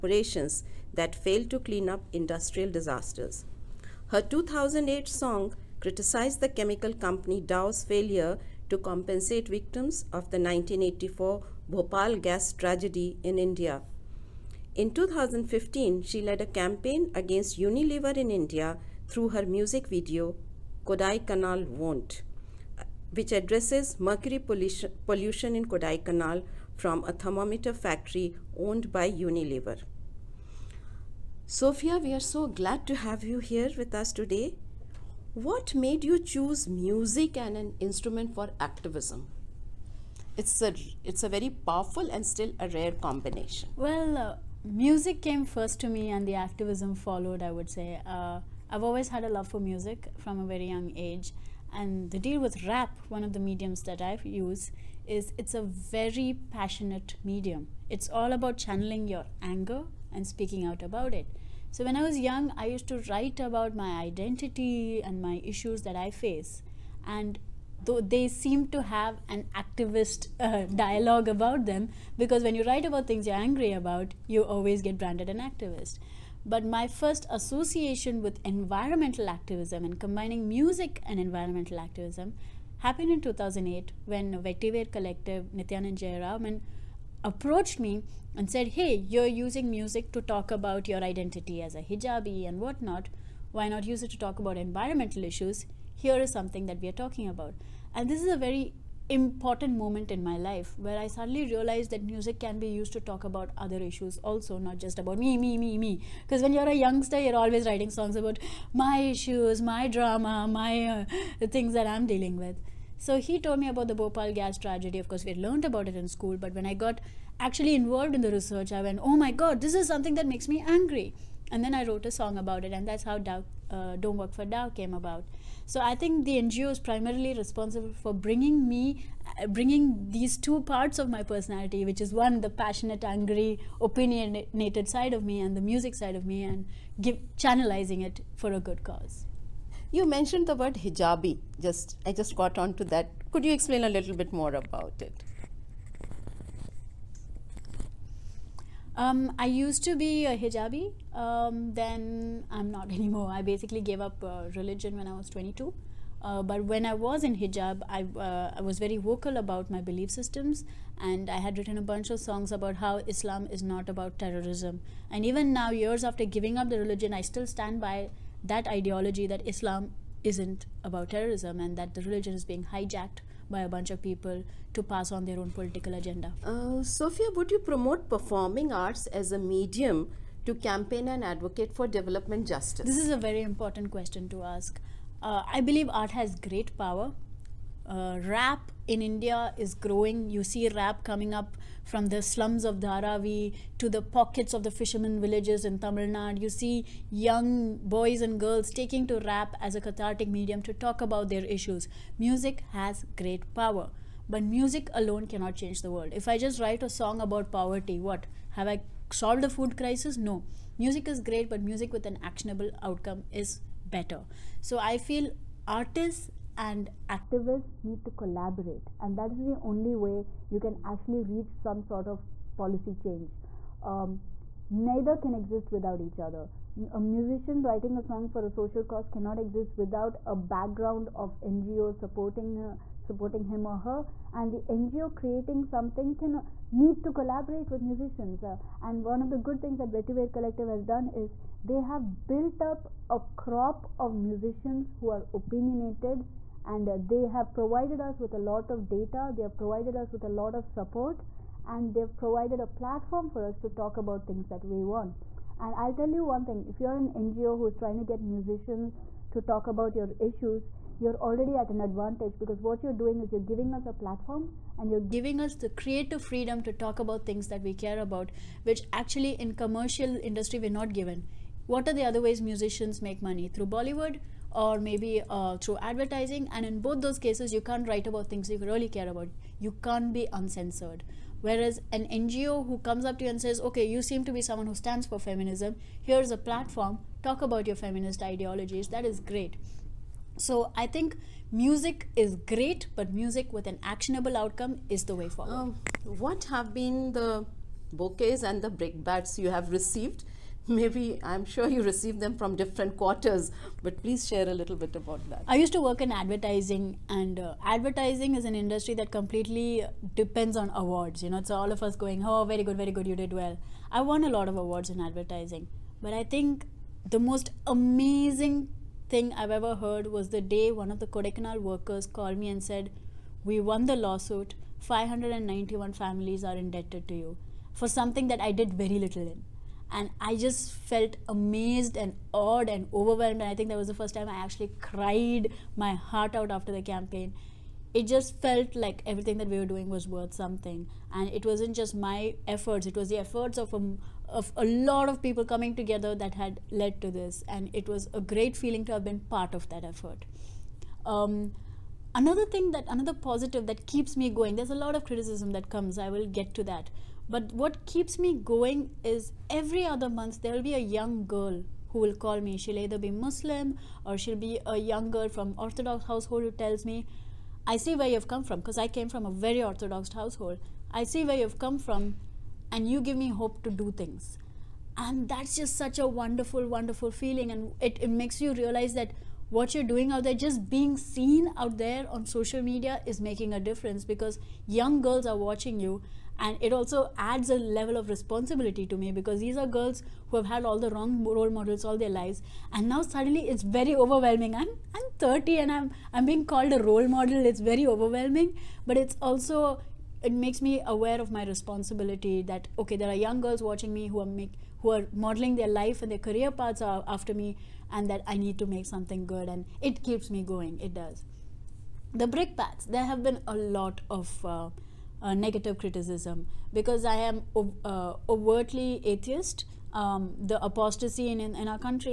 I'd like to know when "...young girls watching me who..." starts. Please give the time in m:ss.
6:43.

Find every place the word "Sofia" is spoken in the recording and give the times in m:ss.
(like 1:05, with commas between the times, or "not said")
0:31, 2:56.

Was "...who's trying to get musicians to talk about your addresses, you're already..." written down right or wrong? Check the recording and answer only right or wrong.
wrong.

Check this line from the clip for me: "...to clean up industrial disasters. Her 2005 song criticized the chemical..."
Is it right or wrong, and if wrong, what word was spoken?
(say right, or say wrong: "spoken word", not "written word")
wrong: "2008", not "2005".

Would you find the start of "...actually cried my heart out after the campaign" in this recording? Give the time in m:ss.
5:34.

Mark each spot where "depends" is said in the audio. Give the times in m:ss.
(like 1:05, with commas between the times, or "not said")
5:10.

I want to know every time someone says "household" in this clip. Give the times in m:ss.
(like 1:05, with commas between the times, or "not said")
6:06, 6:10.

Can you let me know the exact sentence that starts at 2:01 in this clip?
And then I wrote a song about it, and that's how Dow, uh, Don't Work for Dow came about.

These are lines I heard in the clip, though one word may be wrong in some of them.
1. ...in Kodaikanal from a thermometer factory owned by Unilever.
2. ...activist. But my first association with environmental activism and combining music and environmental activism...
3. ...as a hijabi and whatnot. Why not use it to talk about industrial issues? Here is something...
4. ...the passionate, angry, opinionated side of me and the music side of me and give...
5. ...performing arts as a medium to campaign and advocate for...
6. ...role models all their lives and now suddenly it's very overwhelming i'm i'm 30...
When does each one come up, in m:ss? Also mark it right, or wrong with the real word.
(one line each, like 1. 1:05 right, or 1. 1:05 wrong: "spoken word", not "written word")
1. 0:25 right
2. 1:15 right
3. 1:31 wrong: "environmental", not "industrial"
4. 2:12 right
5. 2:58 right
6. 6:31 right.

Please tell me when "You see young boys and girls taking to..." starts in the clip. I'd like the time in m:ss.
3:16.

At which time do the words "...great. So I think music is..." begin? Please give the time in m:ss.
4:49.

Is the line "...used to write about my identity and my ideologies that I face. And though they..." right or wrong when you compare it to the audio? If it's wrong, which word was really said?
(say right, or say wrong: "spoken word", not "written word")
wrong: "issues", not "ideologies".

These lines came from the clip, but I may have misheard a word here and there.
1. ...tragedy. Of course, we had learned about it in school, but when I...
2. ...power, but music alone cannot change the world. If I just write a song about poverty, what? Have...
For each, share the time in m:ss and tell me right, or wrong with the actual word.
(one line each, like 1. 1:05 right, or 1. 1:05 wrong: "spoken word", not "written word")
1. 1:54 right
2. 3:23 right.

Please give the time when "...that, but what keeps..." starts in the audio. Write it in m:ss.
5:56.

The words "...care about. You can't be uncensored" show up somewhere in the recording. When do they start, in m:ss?
4:38.